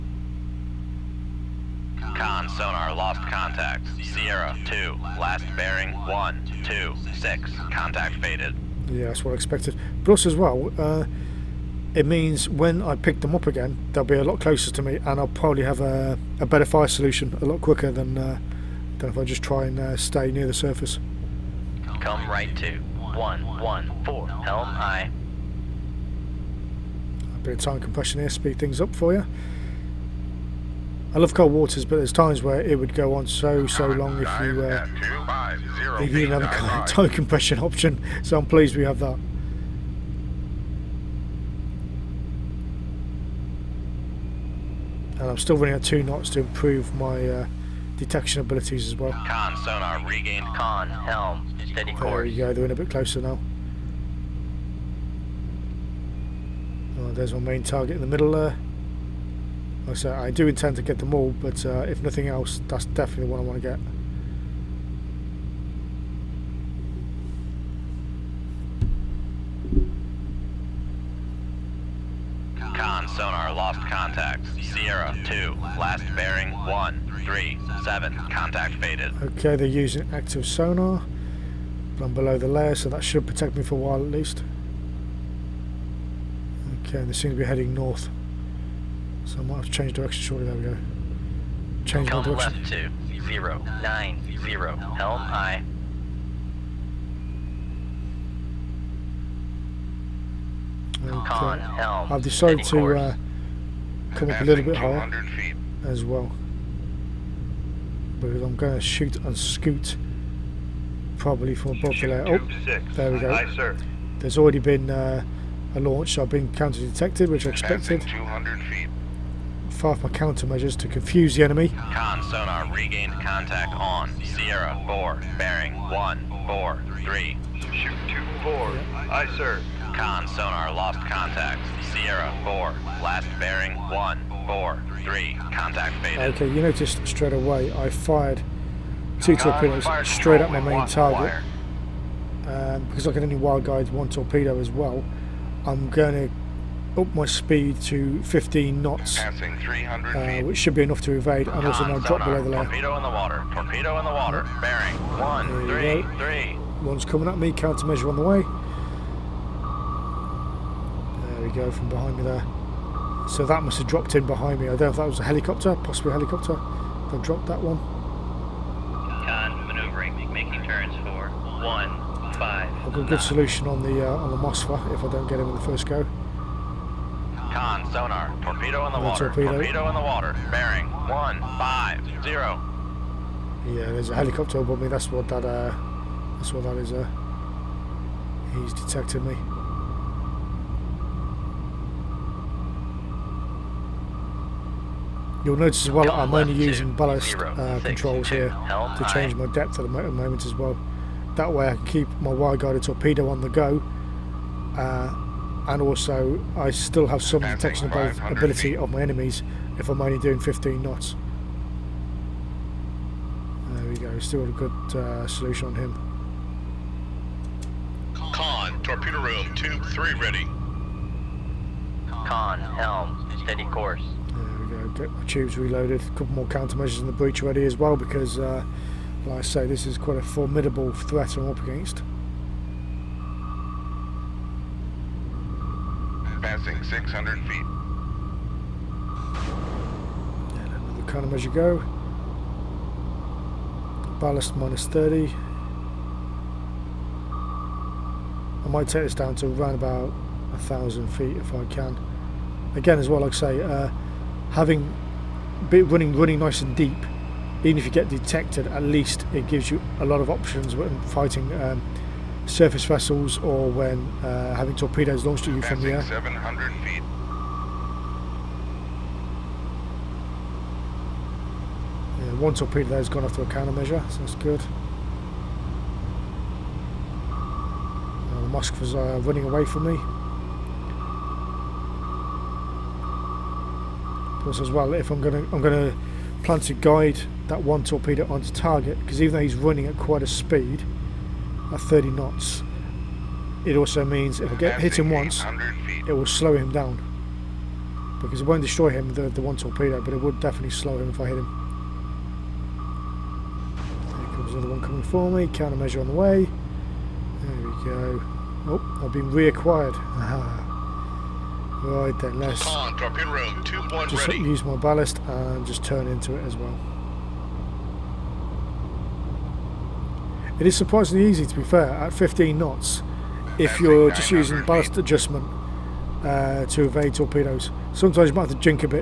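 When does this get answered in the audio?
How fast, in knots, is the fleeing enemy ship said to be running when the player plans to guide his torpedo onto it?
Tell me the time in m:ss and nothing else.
4:51.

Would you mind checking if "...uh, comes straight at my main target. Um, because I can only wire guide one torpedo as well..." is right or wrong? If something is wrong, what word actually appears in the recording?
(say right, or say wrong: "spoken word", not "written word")
wrong: "torpedoes", not "comes".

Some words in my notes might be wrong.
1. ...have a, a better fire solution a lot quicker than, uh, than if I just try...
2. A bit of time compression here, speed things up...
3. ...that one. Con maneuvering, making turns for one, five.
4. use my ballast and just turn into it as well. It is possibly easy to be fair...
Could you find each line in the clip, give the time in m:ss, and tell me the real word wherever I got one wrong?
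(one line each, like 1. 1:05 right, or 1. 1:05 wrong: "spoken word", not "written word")
1. 0:15 right
2. 0:27 right
3. 2:47 right
4. 5:14 wrong: "surprisingly", not "possibly".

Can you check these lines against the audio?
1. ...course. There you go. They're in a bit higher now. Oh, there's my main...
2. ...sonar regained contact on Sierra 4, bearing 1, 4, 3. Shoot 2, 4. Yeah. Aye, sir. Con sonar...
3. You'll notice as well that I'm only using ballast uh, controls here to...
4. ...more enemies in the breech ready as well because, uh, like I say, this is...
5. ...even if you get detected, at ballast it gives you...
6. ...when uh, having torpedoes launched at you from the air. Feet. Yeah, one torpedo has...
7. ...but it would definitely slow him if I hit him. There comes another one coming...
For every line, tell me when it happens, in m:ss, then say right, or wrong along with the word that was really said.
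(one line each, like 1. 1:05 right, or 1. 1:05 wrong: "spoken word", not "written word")
1. 0:51 wrong: "closer", not "higher"
2. 2:02 right
3. 3:15 right
4. 3:46 wrong: "countermeasures", not "enemies"
5. 4:17 wrong: "least", not "ballast"
6. 4:23 right
7. 5:00 right.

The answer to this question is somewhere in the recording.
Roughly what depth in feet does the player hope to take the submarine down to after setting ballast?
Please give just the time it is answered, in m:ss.
4:10.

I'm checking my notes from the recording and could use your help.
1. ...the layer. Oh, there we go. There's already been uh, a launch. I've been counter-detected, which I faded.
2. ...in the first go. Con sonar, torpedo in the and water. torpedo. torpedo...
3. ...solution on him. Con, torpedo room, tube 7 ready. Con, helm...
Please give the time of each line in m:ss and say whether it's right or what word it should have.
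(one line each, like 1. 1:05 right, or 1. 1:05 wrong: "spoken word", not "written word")
1. 1:51 wrong: "expected", not "faded"
2. 2:55 right
3. 3:35 wrong: "3", not "7".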